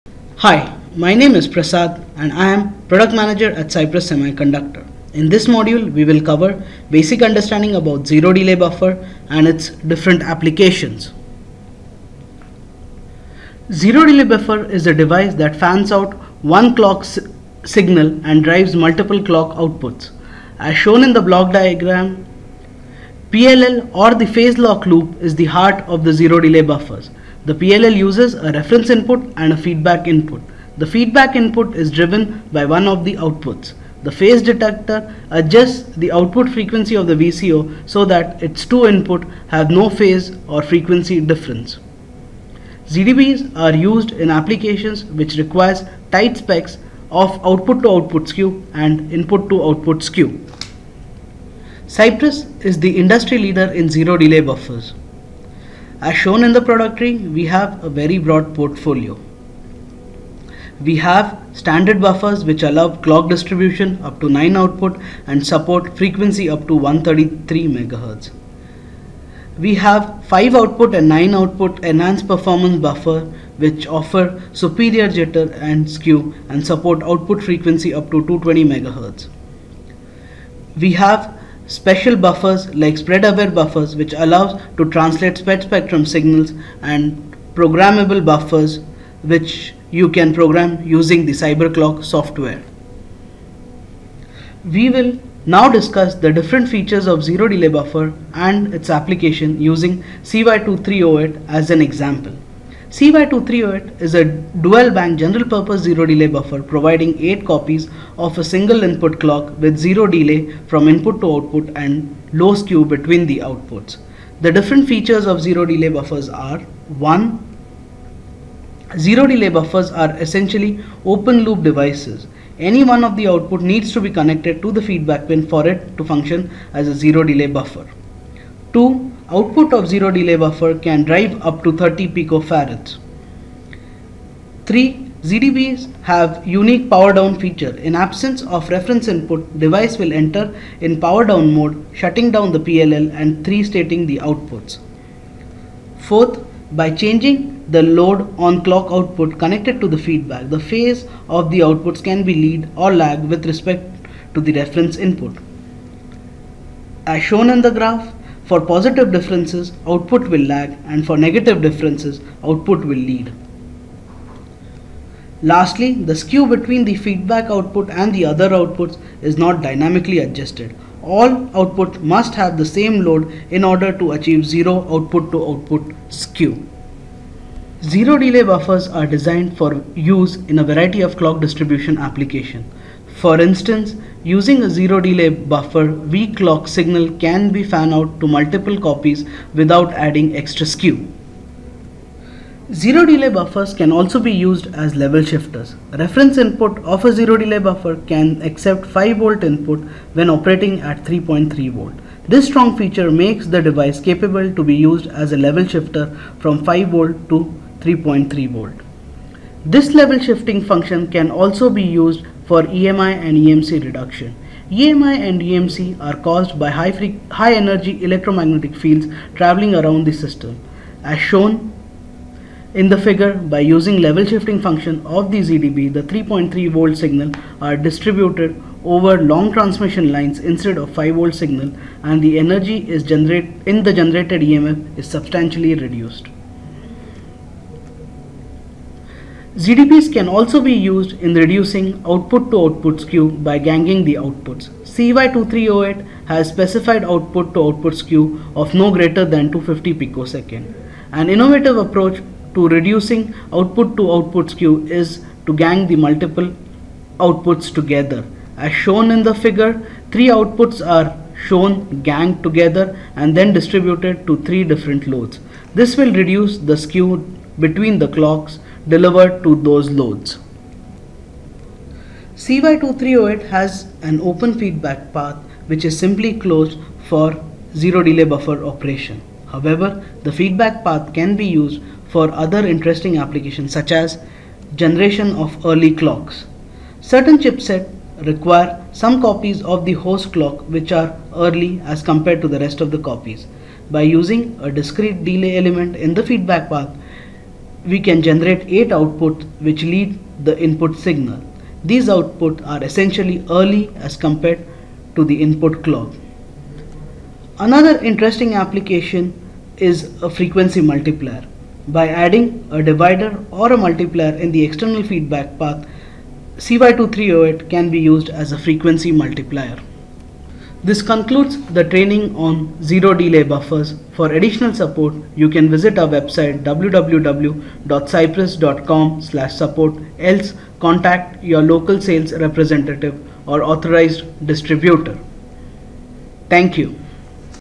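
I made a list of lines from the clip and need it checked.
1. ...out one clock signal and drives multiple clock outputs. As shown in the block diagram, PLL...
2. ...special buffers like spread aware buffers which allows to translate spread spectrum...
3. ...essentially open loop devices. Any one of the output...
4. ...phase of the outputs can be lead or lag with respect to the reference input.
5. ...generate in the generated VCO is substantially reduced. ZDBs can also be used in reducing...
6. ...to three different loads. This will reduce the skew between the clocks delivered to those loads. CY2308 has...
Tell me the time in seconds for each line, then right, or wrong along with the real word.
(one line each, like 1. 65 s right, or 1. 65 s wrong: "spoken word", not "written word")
1. 15 s right
2. 81 s right
3. 120 s right
4. 150 s right
5. 233 s wrong: "EMF", not "VCO"
6. 264 s right.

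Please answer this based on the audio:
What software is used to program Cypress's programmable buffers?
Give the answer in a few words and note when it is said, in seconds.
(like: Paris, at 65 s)
CyberClock, at 91 s.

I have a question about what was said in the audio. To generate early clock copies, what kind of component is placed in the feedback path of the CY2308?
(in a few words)
discrete delay element.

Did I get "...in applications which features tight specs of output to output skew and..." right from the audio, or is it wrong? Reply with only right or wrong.
wrong.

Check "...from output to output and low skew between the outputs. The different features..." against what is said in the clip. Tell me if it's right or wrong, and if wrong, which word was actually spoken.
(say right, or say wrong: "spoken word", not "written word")
wrong: "input", not "output".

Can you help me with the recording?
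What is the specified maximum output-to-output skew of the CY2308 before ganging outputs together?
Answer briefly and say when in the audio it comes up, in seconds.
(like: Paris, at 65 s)
250 picoseconds, at 249 s.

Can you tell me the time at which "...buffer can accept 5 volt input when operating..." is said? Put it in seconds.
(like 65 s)
197 s.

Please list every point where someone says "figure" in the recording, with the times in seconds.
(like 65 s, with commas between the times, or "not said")
222 s, 259 s.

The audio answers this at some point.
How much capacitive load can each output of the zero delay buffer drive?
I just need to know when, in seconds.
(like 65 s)
131 s.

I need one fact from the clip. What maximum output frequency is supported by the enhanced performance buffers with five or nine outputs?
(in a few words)
220 MHz.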